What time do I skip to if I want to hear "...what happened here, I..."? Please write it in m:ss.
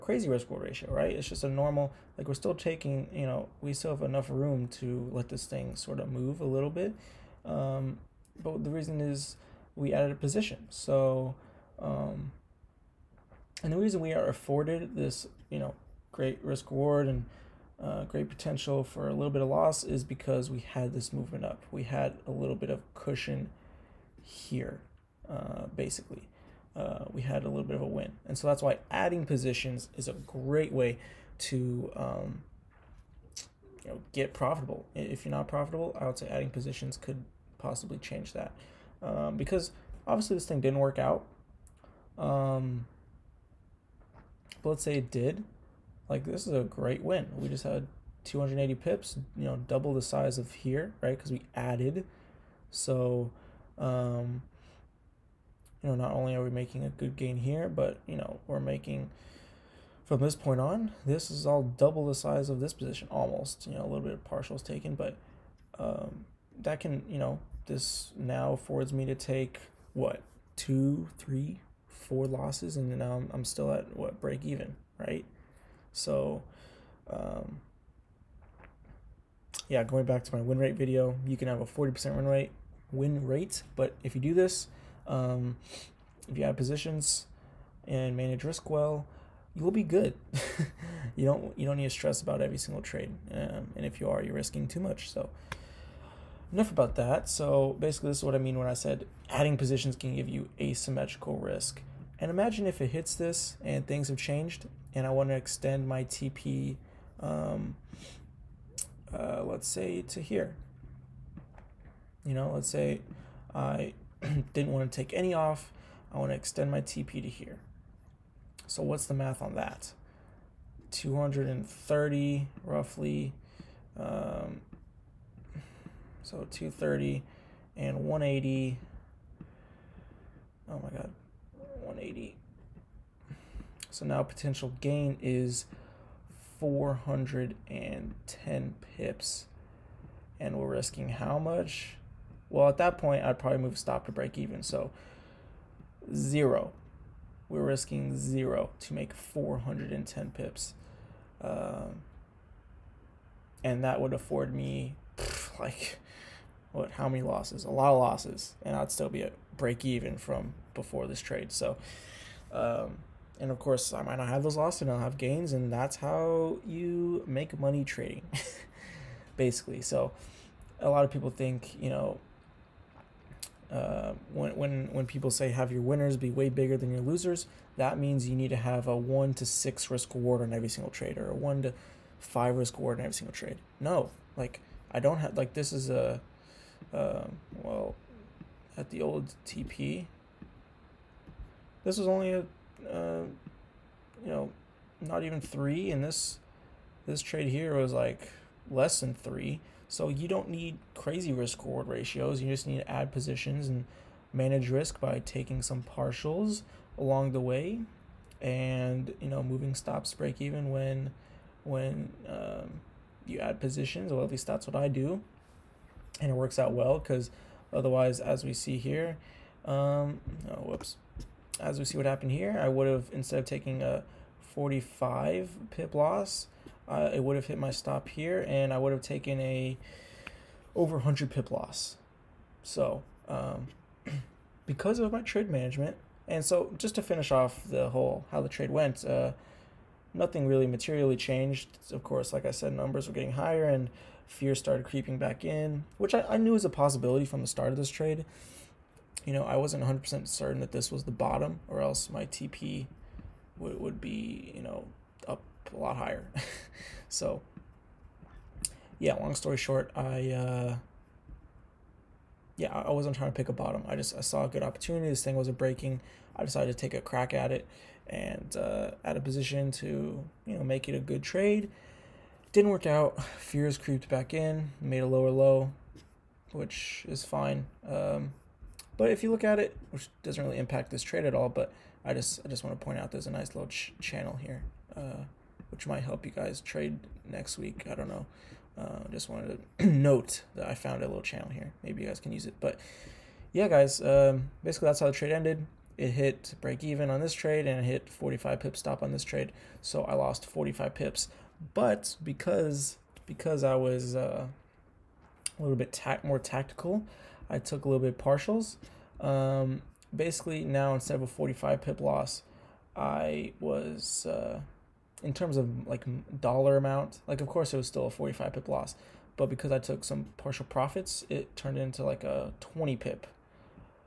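3:41.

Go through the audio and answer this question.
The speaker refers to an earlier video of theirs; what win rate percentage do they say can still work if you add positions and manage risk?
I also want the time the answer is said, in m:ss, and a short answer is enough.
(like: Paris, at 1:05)
40%, at 1:21.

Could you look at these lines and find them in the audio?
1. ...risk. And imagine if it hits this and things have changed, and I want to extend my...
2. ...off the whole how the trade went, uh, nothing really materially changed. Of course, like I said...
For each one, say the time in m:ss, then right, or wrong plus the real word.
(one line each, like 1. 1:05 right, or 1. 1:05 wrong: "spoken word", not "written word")
1. 1:41 right
2. 3:57 right.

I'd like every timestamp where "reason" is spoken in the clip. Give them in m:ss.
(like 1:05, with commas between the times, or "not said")
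0:08, 0:13.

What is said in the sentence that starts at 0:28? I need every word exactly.
And so that's why adding positions is a great way to um, you know, get profitable.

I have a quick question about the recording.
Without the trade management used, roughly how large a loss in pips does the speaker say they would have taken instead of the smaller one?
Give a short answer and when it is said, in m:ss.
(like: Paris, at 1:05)
over 100 pips, at 3:50.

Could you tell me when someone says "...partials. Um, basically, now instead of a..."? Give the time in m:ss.
5:08.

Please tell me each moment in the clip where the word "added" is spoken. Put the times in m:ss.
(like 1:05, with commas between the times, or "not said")
0:09, 0:51.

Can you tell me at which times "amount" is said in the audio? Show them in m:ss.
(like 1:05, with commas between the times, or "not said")
5:16.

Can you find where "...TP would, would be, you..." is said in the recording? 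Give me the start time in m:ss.
4:12.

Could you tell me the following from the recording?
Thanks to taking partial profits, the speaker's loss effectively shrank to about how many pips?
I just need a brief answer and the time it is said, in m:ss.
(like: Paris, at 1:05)
20 pips, at 5:22.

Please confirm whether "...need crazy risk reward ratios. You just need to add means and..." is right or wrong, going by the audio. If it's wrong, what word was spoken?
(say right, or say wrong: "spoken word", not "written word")
wrong: "positions", not "means".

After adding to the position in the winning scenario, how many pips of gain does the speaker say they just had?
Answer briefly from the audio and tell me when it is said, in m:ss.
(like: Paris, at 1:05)
280 pips, at 0:48.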